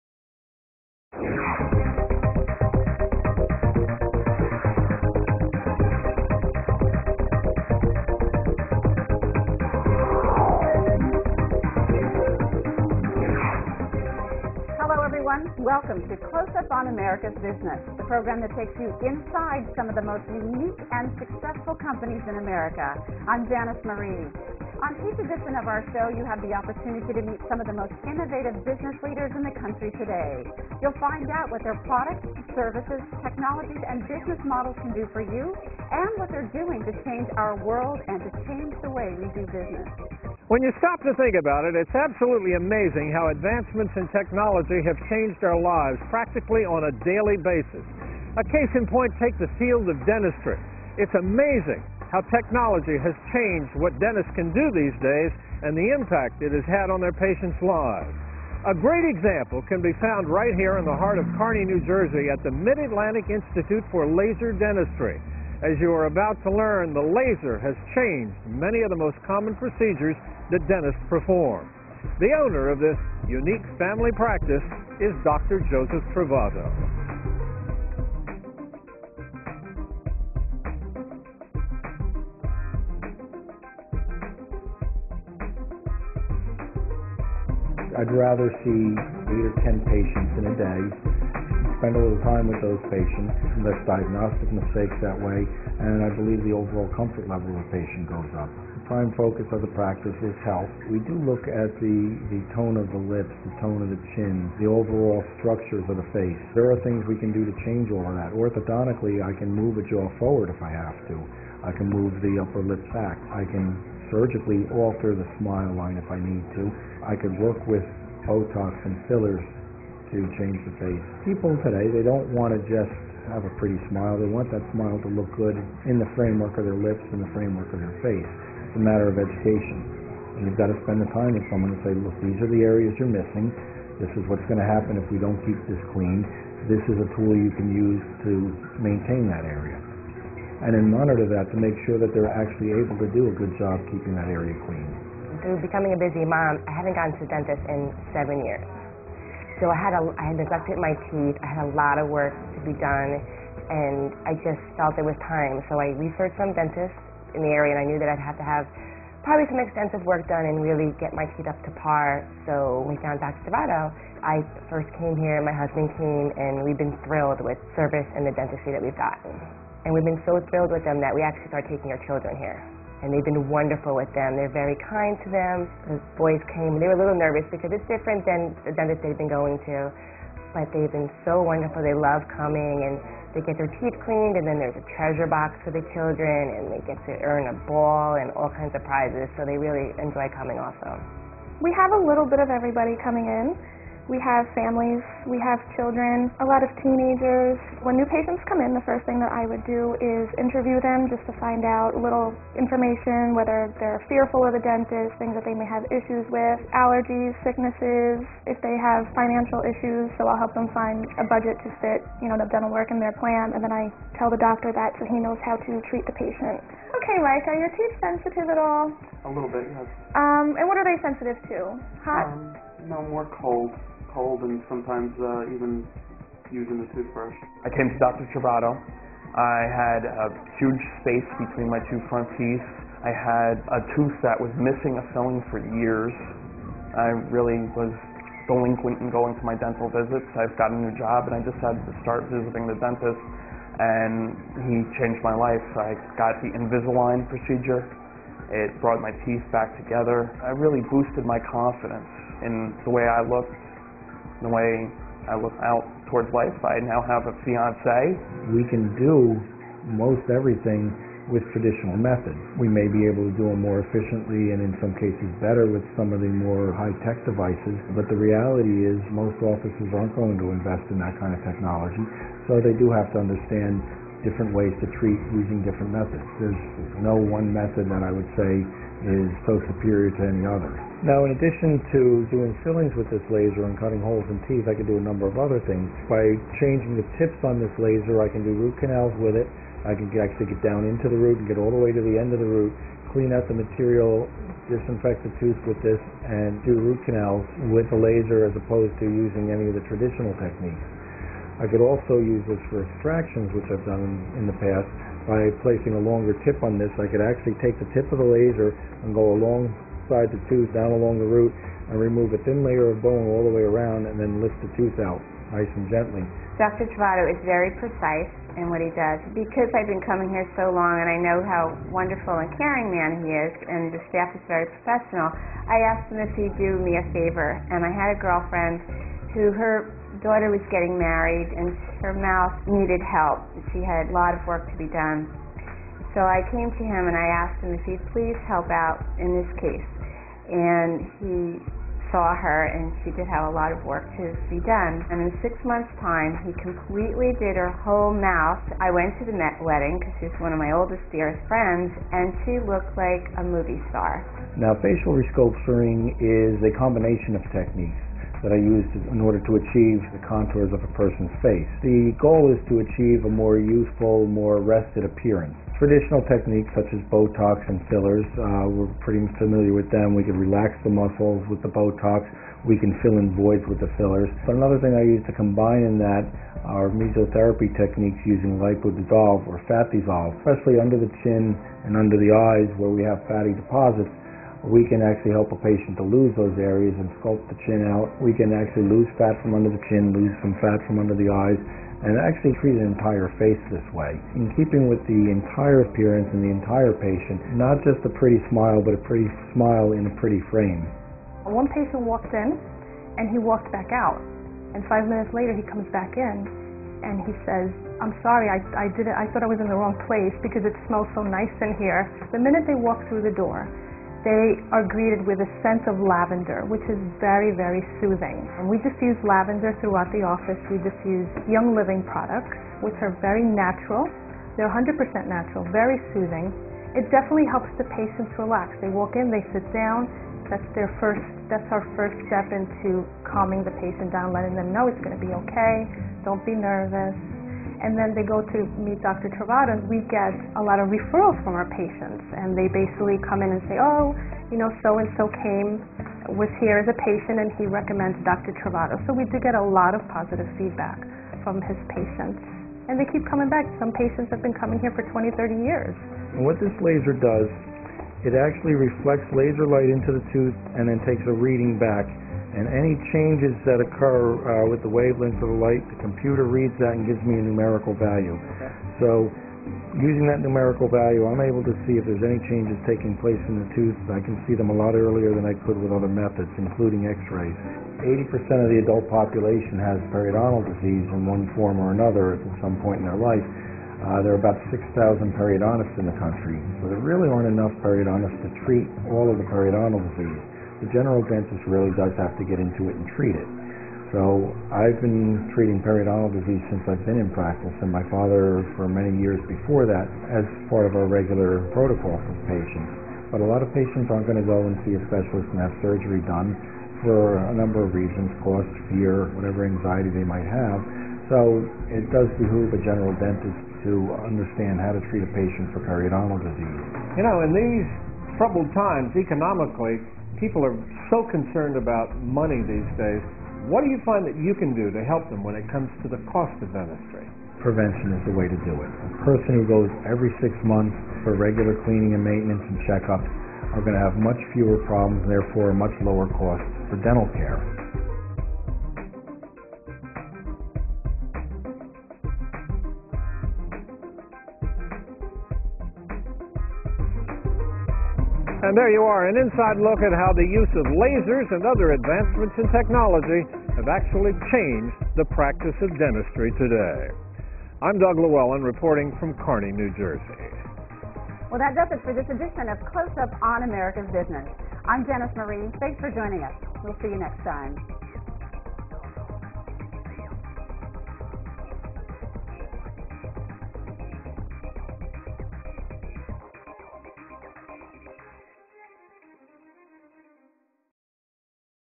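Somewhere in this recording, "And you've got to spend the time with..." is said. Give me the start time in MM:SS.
02:10.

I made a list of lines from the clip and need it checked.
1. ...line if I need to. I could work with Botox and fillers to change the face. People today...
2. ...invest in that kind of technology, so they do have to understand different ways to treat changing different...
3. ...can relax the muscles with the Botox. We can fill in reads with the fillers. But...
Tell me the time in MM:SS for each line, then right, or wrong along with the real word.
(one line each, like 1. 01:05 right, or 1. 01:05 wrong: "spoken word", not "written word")
1. 01:55 right
2. 04:30 wrong: "using", not "changing"
3. 06:10 wrong: "voids", not "reads".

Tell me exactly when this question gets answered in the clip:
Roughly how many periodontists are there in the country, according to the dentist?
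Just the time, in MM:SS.
08:04.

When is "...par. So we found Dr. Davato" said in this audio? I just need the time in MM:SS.
02:41.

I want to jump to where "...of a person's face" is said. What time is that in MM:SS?
06:00.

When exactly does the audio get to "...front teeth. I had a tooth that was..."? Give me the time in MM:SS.
03:52.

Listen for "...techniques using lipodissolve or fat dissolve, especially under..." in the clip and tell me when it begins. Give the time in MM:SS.
06:17.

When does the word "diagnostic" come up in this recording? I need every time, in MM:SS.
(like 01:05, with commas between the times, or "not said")
01:33.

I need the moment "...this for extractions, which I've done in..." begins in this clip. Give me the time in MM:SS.
05:02.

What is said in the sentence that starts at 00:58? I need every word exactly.
A great example can be found right here in the heart of Kearny, New Jersey at the Mid-Atlantic Institute for Laser Dentistry.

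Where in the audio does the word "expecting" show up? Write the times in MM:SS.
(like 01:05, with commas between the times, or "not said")
not said.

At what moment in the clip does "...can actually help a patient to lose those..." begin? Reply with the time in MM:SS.
06:24.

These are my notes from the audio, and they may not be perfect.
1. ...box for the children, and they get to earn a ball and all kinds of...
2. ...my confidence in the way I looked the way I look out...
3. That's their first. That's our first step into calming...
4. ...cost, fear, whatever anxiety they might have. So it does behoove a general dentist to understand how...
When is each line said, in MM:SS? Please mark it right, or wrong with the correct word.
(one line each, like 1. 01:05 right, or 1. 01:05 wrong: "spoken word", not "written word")
1. 03:05 right
2. 04:11 right
3. 07:10 right
4. 08:28 right.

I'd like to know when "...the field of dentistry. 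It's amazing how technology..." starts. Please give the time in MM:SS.
00:49.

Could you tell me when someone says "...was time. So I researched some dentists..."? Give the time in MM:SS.
02:35.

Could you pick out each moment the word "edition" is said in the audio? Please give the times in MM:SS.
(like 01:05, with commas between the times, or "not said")
00:25, 09:22.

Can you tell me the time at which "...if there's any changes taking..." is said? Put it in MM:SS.
07:51.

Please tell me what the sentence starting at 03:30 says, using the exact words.
So I'll help them find a budget to fit, you know, the dental work in their plan.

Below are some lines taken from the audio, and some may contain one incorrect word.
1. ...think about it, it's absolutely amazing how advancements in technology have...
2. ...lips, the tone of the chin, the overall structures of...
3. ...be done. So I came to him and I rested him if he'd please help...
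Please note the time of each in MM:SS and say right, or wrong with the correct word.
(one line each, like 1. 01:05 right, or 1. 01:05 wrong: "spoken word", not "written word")
1. 00:41 right
2. 01:42 right
3. 05:34 wrong: "asked", not "rested".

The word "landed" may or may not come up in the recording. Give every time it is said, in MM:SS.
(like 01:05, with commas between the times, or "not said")
not said.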